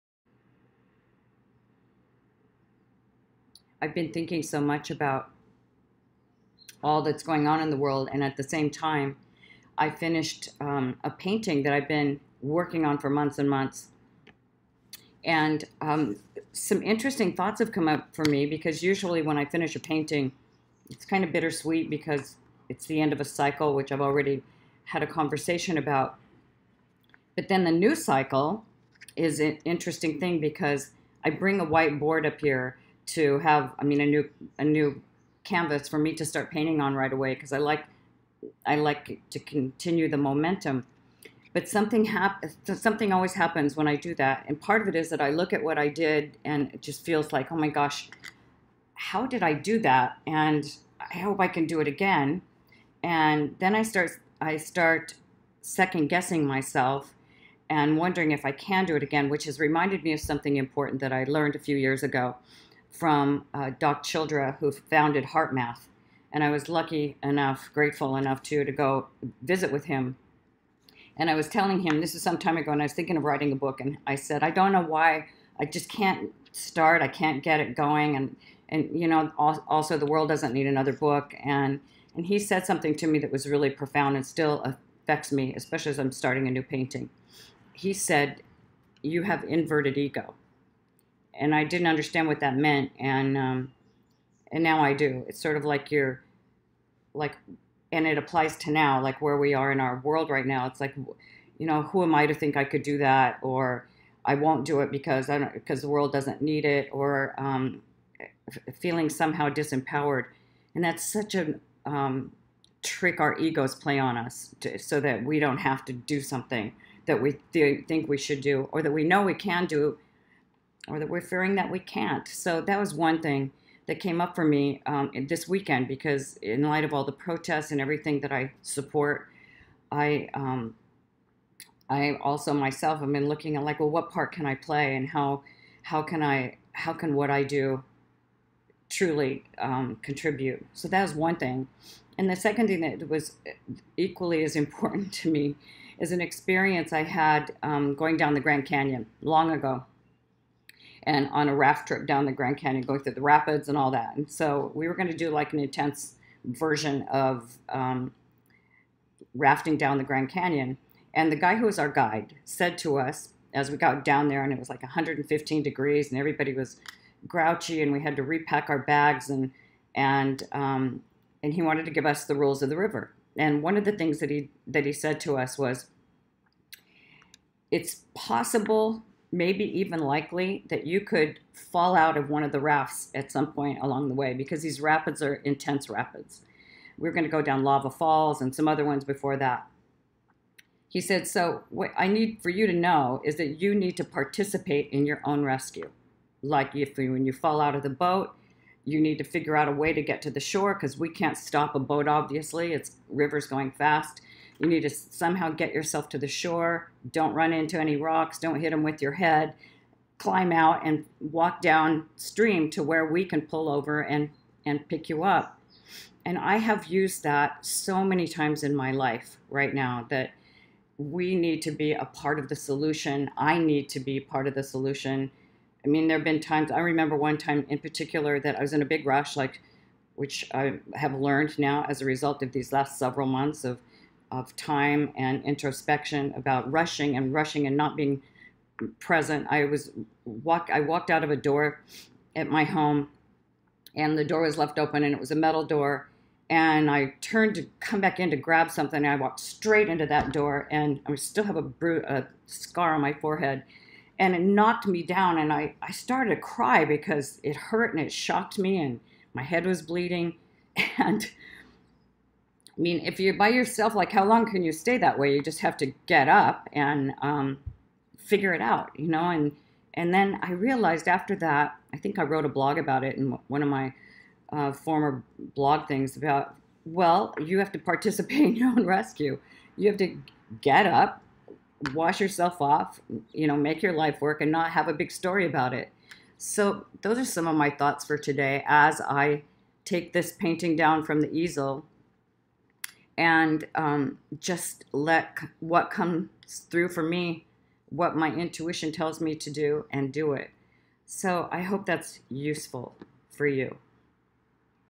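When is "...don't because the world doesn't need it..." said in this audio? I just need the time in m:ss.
1:45.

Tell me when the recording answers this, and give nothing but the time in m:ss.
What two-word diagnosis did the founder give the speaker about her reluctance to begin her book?
1:29.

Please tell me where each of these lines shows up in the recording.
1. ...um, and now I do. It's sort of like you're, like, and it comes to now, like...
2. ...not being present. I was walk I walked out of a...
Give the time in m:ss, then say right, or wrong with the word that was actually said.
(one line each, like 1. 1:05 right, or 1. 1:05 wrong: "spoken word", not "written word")
1. 1:33 wrong: "applies", not "comes"
2. 3:57 right.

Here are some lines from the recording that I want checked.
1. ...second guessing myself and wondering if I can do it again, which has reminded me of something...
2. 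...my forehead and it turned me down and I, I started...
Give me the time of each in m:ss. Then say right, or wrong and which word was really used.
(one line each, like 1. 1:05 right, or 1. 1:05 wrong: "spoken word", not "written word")
1. 0:55 right
2. 4:13 wrong: "knocked", not "turned".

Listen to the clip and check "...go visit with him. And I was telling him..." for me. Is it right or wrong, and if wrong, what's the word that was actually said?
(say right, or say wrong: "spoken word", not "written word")
right.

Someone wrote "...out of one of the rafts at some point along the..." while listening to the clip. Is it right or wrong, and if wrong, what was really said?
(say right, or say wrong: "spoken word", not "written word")
right.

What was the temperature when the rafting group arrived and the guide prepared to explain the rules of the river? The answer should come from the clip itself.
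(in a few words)
115 degrees.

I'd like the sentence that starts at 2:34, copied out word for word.
And so we were going to do like an intense version of um, rafting down the Grand Canyon.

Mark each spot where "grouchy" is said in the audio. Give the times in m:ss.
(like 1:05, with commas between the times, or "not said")
2:47.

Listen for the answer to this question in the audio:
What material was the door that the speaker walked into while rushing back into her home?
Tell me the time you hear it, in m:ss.
4:05.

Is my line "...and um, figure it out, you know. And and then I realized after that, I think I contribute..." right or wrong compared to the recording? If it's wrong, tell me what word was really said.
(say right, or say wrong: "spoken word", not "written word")
wrong: "wrote", not "contribute".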